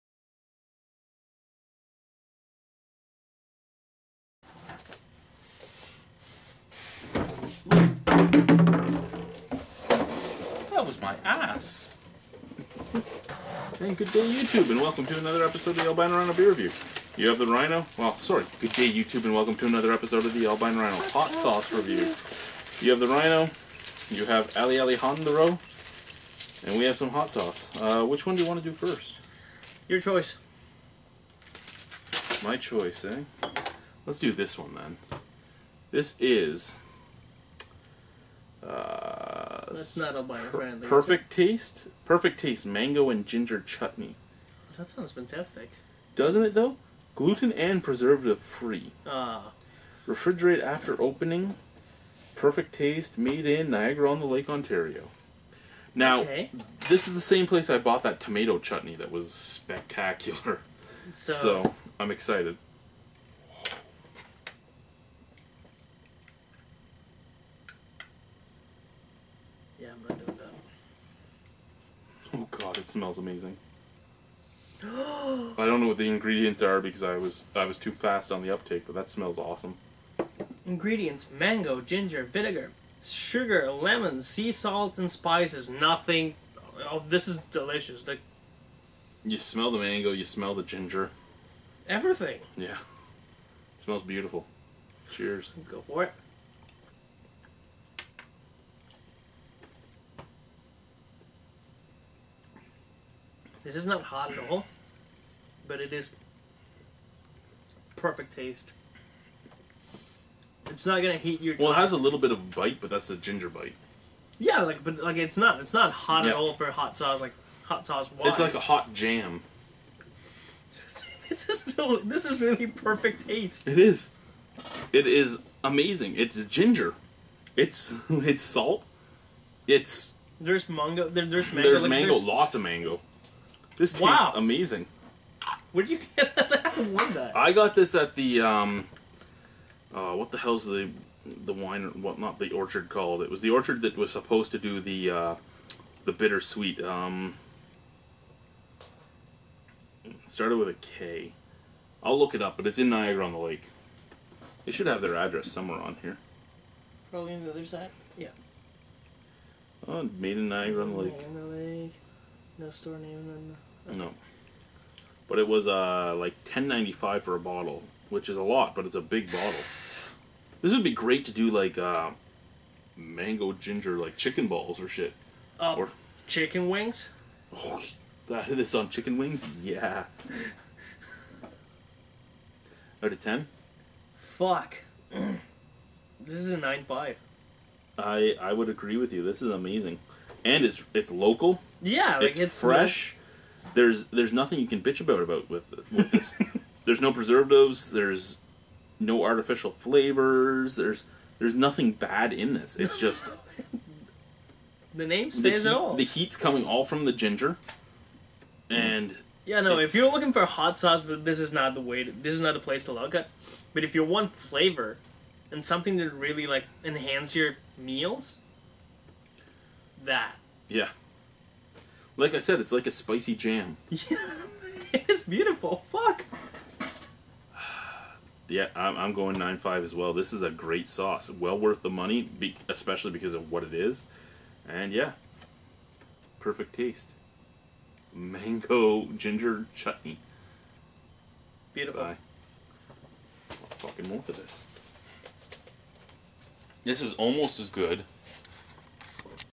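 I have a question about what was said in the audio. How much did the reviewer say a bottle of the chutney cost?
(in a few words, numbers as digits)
10.95.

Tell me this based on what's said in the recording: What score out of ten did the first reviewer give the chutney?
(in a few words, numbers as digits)
9.5.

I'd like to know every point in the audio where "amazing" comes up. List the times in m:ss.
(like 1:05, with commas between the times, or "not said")
1:13, 2:05, 2:14, 3:09.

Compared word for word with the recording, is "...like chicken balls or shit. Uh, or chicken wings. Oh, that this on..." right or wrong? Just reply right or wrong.
right.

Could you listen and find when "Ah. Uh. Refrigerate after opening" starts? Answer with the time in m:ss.
0:49.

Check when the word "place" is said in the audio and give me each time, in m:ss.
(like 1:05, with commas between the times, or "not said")
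0:57, 3:32.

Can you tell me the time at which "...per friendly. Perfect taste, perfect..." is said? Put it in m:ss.
0:40.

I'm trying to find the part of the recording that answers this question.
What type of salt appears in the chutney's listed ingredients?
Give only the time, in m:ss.
1:24.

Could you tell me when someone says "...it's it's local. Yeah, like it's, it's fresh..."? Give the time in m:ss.
3:10.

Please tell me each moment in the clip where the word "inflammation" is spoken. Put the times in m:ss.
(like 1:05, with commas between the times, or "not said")
not said.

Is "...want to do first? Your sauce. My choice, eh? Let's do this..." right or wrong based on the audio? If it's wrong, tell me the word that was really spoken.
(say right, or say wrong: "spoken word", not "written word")
wrong: "choice", not "sauce".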